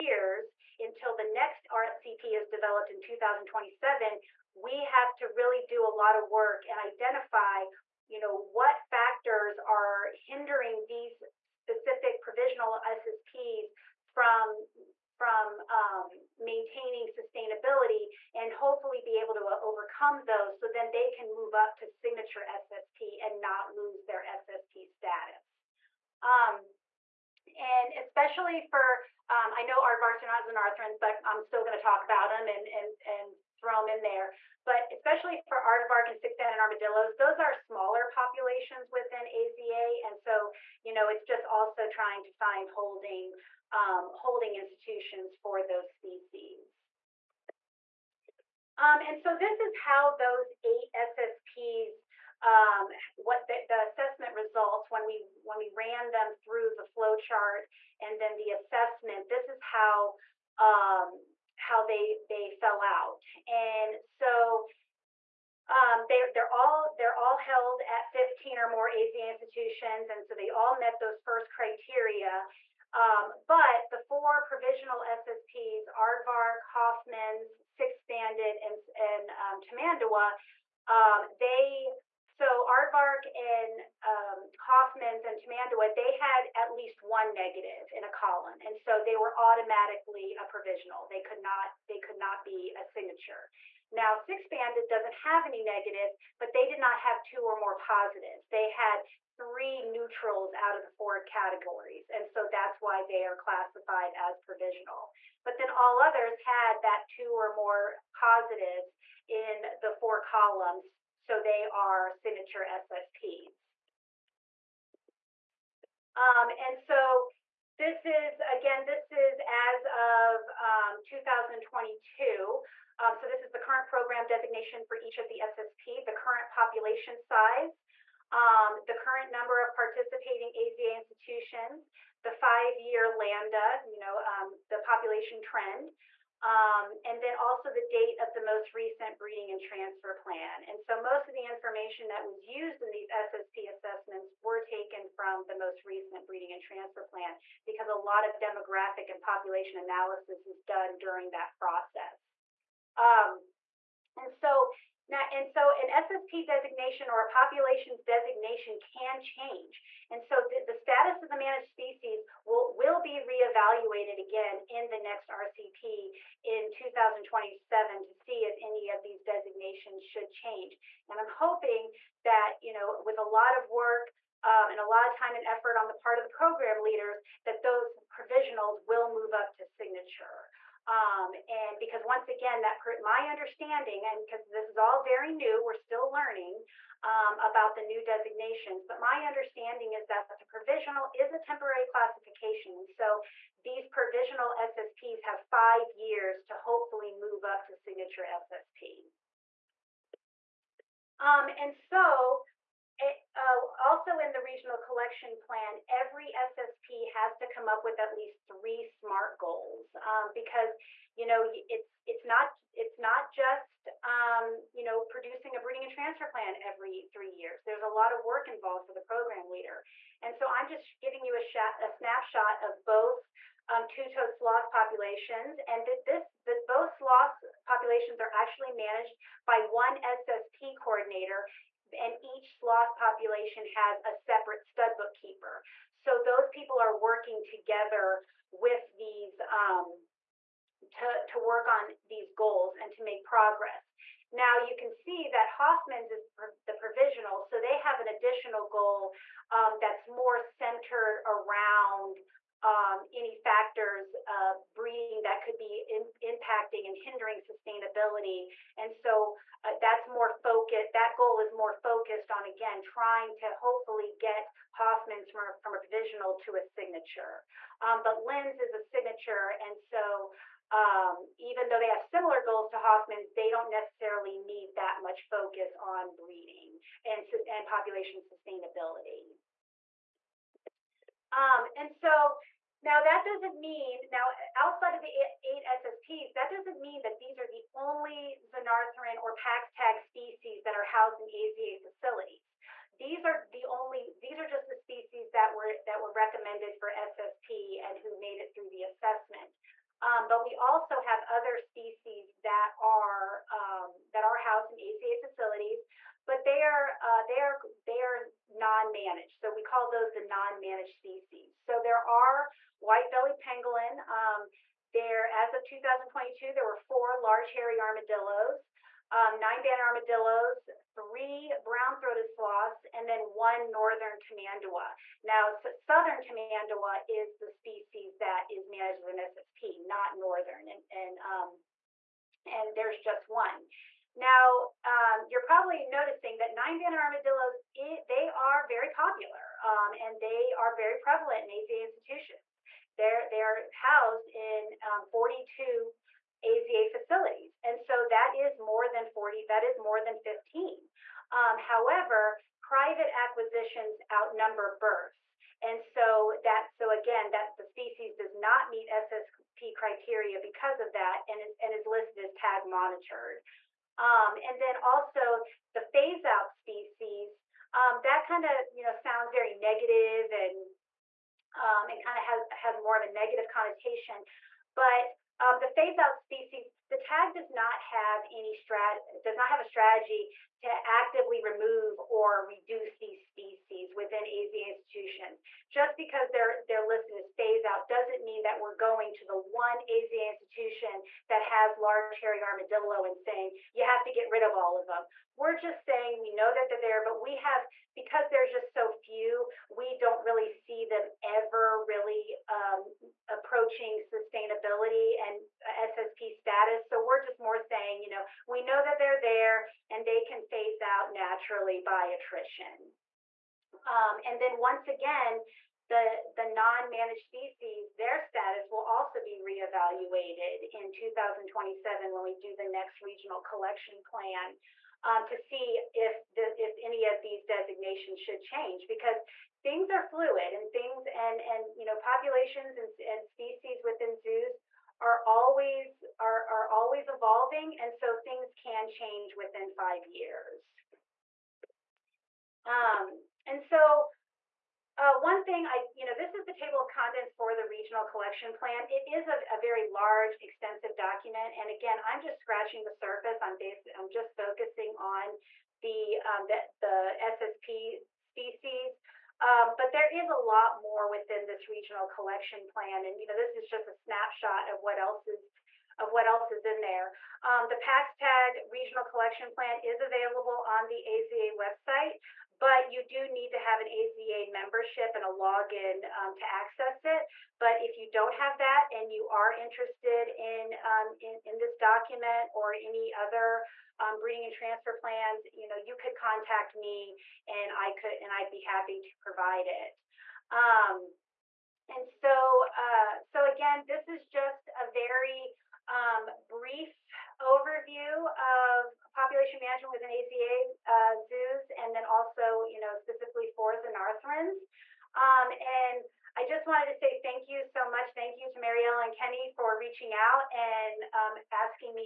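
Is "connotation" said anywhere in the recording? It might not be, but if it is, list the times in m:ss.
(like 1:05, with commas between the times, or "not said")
6:13.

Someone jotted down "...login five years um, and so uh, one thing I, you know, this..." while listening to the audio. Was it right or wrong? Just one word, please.
wrong.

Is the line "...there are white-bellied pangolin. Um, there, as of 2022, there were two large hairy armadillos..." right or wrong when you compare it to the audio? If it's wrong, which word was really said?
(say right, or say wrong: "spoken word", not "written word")
wrong: "four", not "two".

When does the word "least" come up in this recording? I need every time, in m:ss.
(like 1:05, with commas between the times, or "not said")
1:26, 3:28.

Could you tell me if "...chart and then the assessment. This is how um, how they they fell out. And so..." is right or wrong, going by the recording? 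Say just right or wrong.
right.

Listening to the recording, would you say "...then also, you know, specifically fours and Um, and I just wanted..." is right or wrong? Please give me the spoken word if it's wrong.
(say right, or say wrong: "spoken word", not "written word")
right.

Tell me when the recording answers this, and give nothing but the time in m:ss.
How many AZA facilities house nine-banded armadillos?
5:45.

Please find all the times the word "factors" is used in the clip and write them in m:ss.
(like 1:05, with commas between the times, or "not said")
0:08, 4:13.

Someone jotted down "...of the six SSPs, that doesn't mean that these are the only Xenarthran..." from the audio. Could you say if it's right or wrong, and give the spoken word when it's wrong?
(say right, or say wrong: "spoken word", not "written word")
wrong: "eight", not "six".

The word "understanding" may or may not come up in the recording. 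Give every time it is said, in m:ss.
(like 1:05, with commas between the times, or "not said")
3:03, 3:09.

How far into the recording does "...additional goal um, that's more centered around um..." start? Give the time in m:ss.
4:08.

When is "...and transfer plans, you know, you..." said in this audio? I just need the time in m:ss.
8:04.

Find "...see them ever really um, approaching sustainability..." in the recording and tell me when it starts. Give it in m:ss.
6:40.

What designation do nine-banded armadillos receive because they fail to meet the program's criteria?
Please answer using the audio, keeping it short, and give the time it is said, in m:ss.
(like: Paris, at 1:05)
TAG monitored, at 6:02.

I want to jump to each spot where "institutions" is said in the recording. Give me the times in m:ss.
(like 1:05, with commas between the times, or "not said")
0:44, 1:09, 2:10, 5:41, 6:24, 6:30.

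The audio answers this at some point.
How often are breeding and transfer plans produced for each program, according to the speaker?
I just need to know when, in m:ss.
3:36.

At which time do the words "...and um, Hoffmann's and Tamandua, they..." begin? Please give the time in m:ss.
1:23.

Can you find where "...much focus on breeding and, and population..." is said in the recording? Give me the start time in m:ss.
4:35.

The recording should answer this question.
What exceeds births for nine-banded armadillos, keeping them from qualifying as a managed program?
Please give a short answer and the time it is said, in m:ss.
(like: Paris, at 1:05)
Private acquisitions, at 5:52.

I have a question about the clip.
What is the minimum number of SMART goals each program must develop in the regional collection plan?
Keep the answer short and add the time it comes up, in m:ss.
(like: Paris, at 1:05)
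3, at 3:27.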